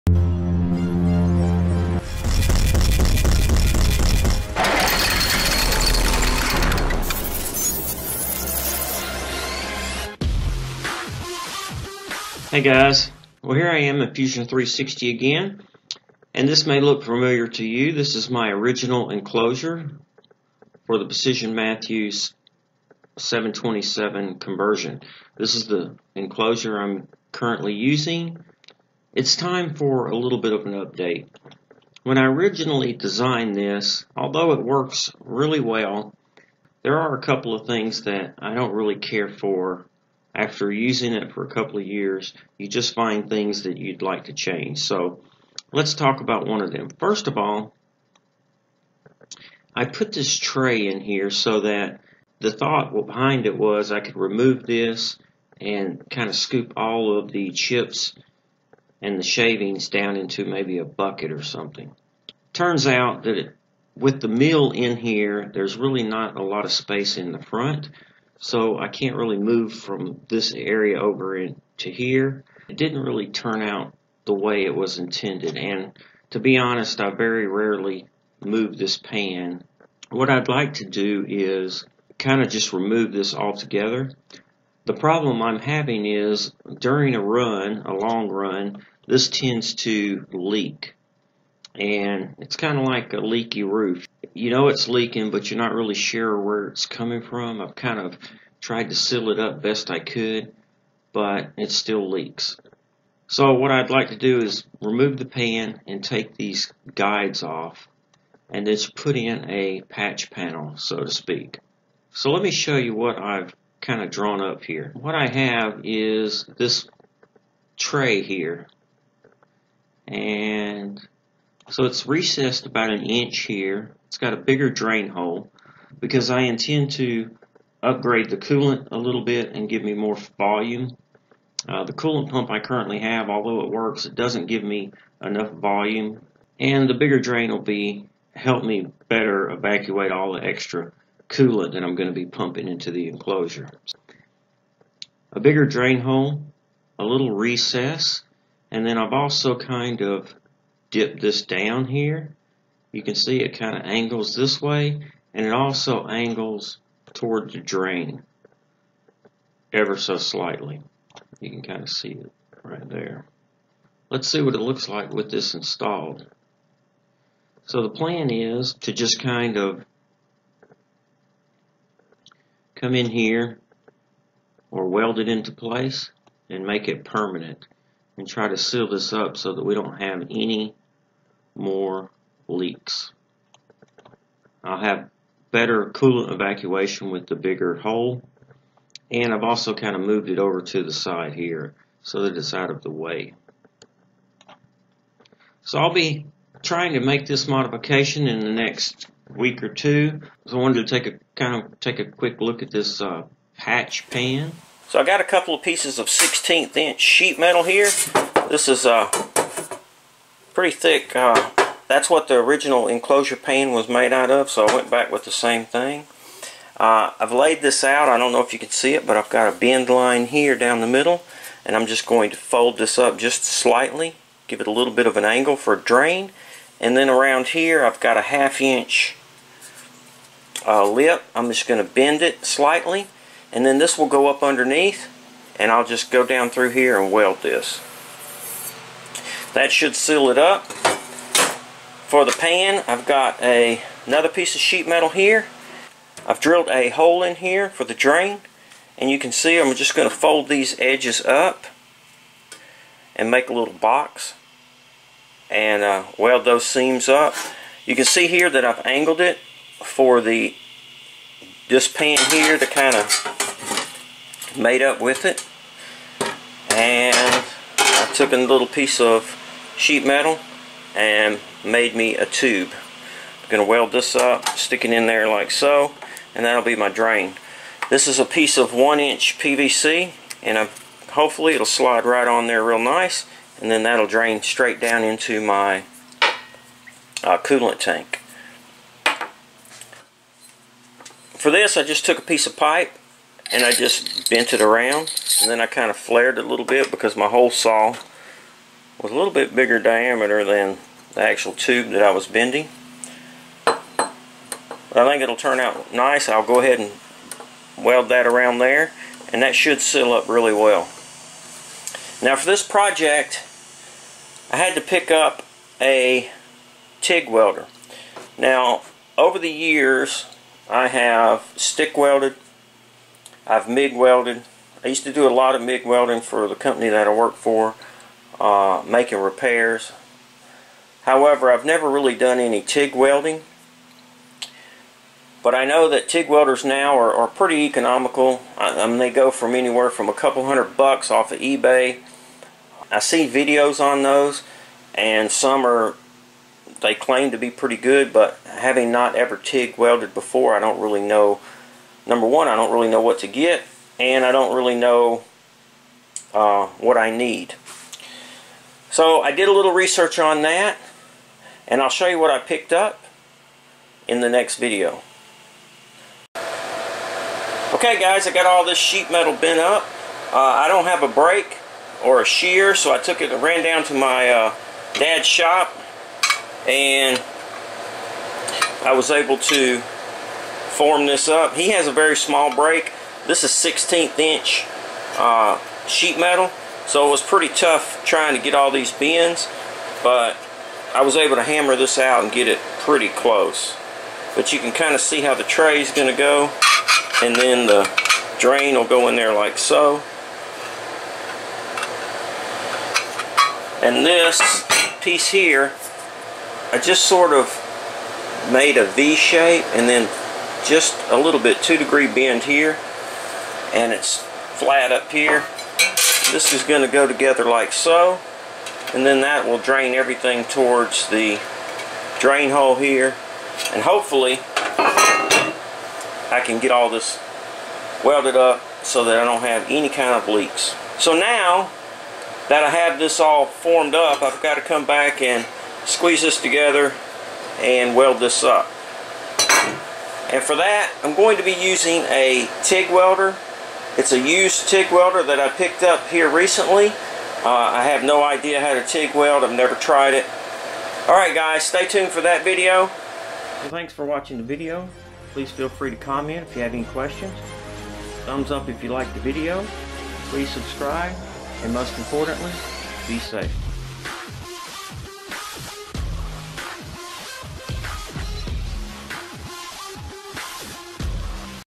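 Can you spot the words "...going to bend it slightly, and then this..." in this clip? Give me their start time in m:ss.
3:51.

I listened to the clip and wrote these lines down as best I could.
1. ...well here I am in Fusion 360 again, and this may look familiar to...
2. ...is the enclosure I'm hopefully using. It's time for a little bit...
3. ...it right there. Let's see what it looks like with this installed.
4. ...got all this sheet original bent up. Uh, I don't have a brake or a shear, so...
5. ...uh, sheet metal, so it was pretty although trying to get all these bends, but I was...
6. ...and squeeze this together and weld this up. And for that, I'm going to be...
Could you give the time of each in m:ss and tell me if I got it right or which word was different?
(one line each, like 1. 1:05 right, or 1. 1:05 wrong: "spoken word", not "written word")
1. 0:13 right
2. 0:25 wrong: "currently", not "hopefully"
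3. 2:42 right
4. 6:08 wrong: "metal", not "original"
5. 6:25 wrong: "tough", not "although"
6. 7:15 right.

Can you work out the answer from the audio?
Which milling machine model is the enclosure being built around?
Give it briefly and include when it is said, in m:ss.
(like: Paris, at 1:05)
Precision Matthews 727, at 0:21.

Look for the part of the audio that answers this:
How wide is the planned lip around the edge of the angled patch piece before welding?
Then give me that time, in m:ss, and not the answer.
3:48.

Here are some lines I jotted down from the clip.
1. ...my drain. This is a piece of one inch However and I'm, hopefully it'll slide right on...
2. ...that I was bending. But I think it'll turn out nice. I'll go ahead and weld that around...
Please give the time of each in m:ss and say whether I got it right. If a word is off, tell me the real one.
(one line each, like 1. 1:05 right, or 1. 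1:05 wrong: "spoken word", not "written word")
1. 4:36 wrong: "PVC", not "However"
2. 5:01 right.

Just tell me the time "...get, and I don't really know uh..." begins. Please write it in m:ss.
5:53.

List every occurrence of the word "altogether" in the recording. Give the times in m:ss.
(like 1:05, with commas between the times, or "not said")
1:23.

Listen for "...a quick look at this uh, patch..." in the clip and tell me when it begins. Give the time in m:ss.
3:21.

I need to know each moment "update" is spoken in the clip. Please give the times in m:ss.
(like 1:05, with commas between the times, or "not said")
0:30.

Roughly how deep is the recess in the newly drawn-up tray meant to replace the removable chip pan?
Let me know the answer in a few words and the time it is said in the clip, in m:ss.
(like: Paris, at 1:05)
about an inch, at 2:02.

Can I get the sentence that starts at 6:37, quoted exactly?
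And then the drain will go in there like so.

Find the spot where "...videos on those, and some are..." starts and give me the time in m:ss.
5:43.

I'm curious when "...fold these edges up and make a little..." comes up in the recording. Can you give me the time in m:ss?
4:10.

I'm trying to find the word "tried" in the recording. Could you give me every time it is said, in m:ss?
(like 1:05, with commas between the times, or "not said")
1:38, 7:29.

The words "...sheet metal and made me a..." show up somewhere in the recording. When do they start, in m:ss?
4:29.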